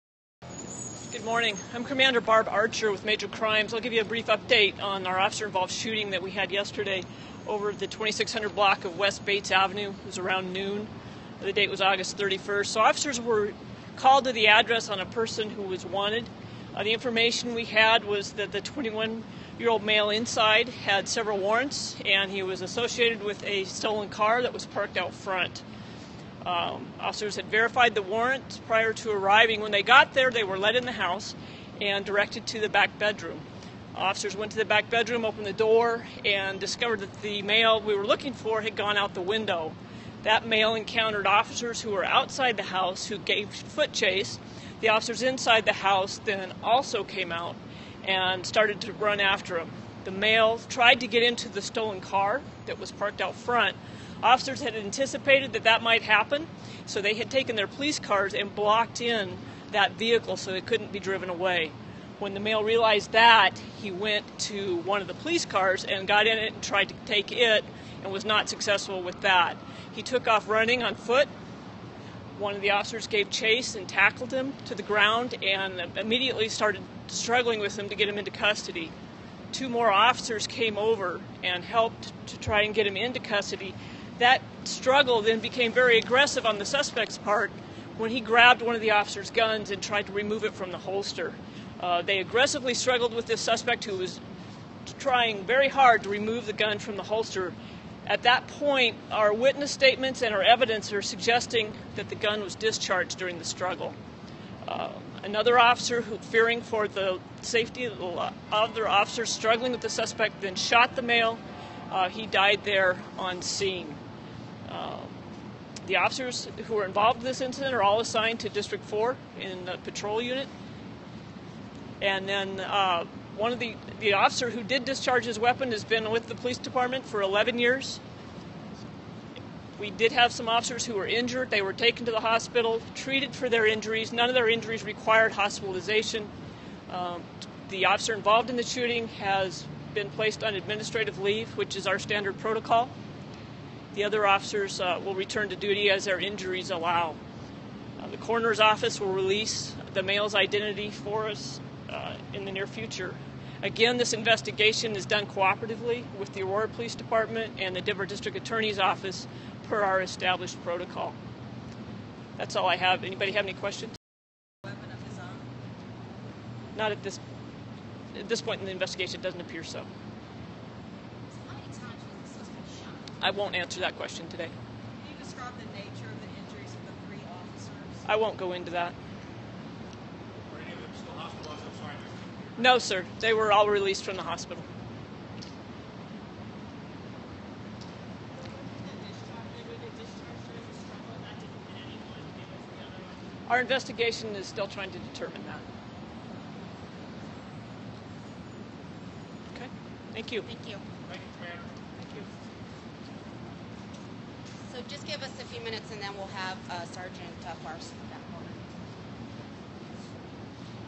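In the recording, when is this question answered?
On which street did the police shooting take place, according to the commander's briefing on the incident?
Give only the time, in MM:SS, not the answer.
00:08.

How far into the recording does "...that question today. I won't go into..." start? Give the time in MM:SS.
02:53.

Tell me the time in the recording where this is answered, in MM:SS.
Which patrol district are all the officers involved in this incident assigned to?
01:58.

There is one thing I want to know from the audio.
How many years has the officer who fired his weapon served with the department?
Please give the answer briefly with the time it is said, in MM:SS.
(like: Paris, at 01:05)
11, at 02:07.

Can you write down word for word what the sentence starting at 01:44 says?
Uh, another officer who, fearing for the safety of the other officer struggling with the suspect, then shot the male.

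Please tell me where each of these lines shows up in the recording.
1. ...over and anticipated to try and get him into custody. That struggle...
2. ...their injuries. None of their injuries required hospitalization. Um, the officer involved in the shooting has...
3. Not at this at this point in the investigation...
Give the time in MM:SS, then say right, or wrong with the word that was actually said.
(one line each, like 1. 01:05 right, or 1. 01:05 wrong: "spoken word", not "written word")
1. 01:20 wrong: "helped", not "anticipated"
2. 02:13 right
3. 02:46 right.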